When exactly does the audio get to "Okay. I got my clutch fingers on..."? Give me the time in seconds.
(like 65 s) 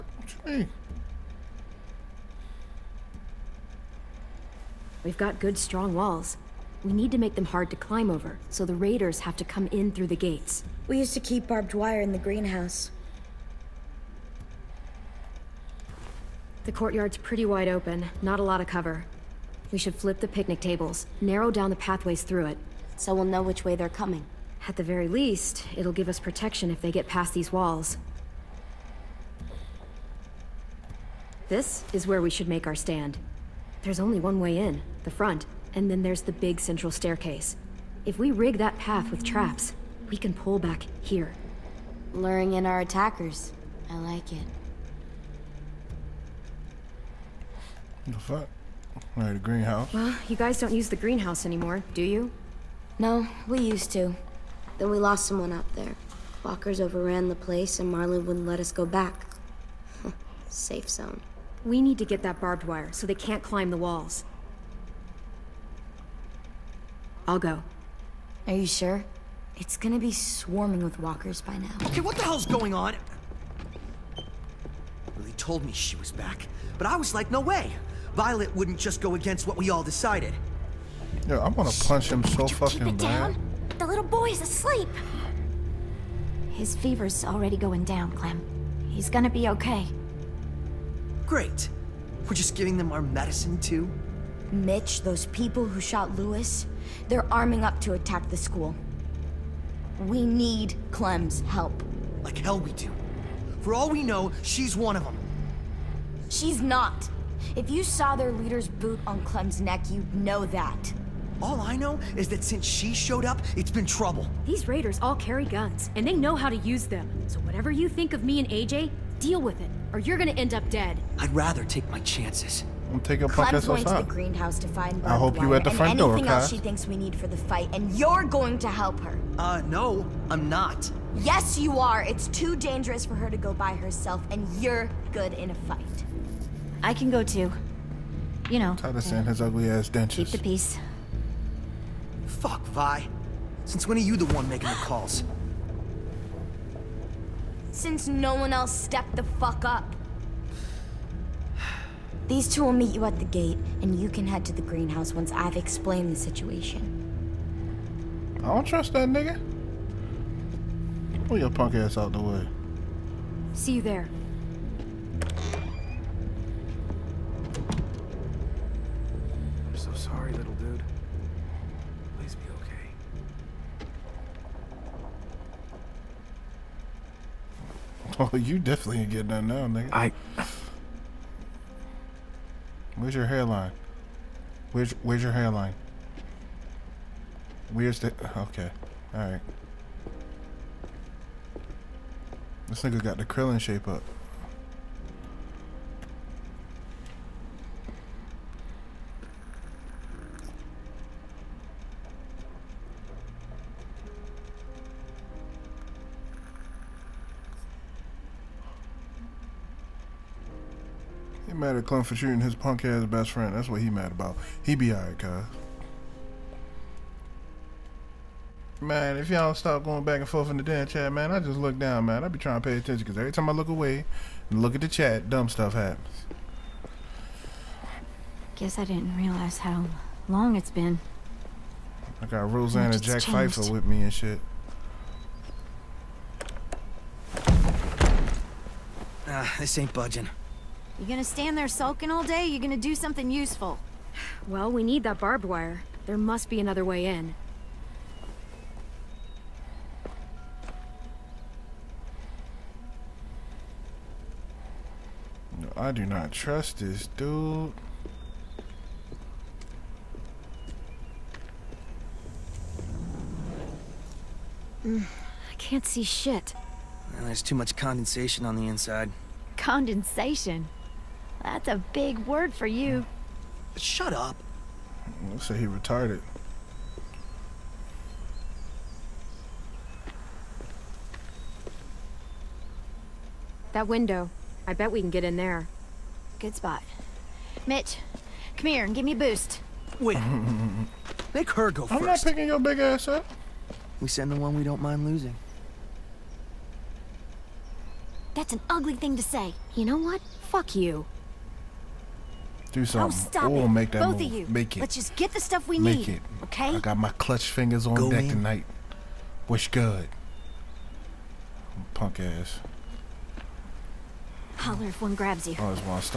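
306 s.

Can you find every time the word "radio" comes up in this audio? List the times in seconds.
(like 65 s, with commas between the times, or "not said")
not said.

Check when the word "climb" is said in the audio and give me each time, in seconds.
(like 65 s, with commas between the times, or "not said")
7 s, 63 s.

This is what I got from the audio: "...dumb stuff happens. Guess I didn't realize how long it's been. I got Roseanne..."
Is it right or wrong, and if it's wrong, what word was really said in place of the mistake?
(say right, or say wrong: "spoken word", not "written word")
right.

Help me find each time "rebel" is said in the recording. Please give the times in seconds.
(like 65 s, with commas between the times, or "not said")
not said.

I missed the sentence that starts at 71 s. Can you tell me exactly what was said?
Okay, what the hell's going on?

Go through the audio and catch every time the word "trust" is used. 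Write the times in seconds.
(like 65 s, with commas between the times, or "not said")
158 s, 256 s.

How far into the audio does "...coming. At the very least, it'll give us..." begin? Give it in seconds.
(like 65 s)
23 s.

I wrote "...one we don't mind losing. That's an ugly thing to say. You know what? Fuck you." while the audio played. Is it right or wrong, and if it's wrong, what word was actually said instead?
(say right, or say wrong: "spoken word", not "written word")
right.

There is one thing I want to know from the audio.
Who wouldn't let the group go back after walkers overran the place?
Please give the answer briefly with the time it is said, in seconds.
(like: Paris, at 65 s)
Marlon, at 57 s.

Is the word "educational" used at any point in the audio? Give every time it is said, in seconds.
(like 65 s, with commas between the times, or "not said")
not said.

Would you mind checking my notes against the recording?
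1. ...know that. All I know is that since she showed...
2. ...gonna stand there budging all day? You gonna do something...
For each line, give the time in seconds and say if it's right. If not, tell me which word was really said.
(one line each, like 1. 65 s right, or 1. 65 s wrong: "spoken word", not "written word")
1. 110 s right
2. 241 s wrong: "sulking", not "budging".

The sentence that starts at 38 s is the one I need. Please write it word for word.
If we rig that path with traps, we can pull back here.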